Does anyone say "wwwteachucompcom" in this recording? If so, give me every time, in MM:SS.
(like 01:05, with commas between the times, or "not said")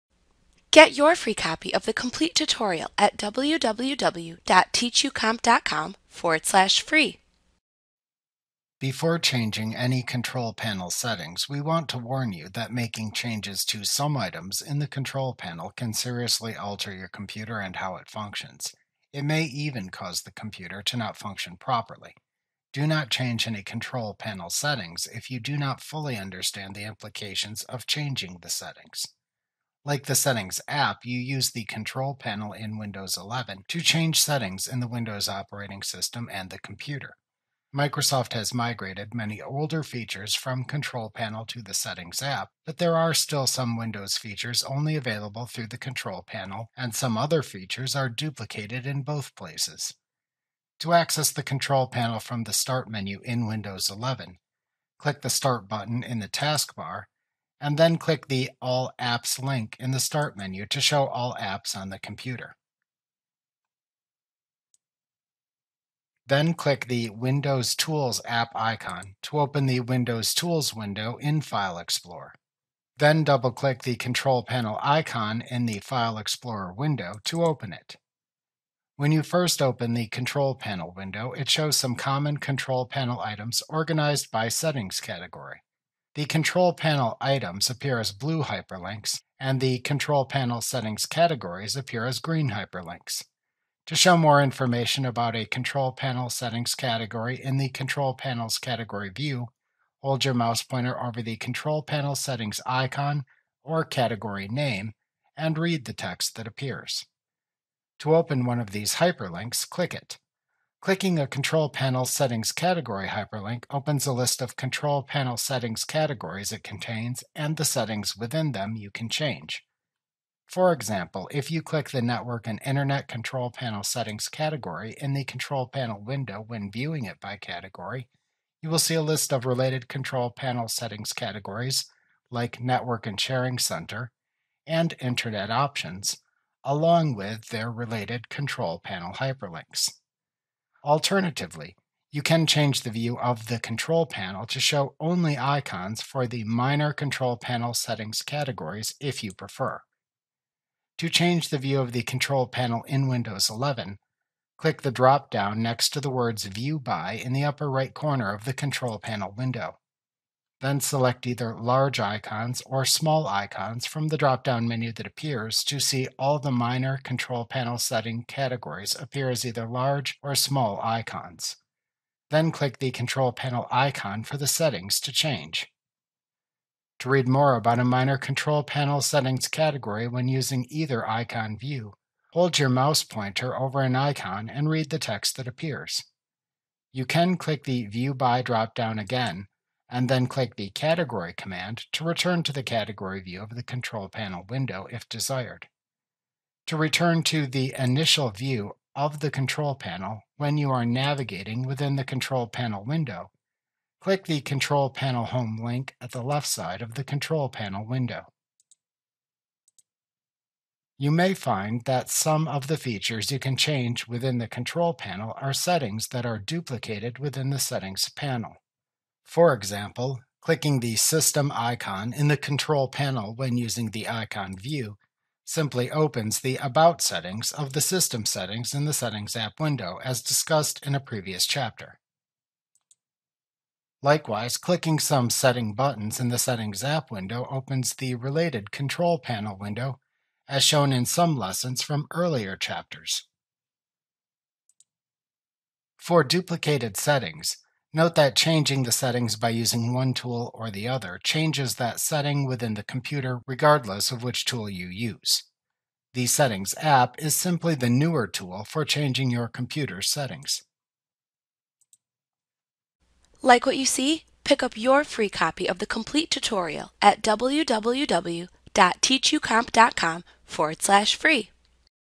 00:03, 04:27.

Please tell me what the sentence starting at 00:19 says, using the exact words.
It may even cause the computer to not function properly.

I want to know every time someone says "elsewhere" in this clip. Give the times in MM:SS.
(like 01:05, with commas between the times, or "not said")
not said.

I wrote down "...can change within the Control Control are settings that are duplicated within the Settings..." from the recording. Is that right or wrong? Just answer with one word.
wrong.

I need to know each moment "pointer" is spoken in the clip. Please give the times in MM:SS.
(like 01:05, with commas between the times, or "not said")
01:40, 03:03.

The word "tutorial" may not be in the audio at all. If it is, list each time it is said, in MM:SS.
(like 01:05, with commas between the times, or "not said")
00:02, 04:26.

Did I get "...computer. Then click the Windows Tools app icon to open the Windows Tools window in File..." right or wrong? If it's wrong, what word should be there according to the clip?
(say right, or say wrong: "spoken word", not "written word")
right.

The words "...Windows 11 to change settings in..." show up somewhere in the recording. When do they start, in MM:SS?
00:32.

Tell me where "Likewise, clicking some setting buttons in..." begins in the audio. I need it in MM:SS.
03:54.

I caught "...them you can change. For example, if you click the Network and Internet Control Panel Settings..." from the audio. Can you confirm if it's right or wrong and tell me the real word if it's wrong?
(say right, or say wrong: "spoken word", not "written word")
right.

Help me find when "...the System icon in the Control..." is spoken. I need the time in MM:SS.
03:40.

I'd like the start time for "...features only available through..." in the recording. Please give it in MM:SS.
00:44.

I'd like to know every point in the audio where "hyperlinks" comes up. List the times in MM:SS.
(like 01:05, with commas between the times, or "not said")
01:28, 01:32, 01:48, 01:53, 02:19.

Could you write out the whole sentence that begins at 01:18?
When you first open the Control Panel window, it shows some common Control Panel items organized by Settings category.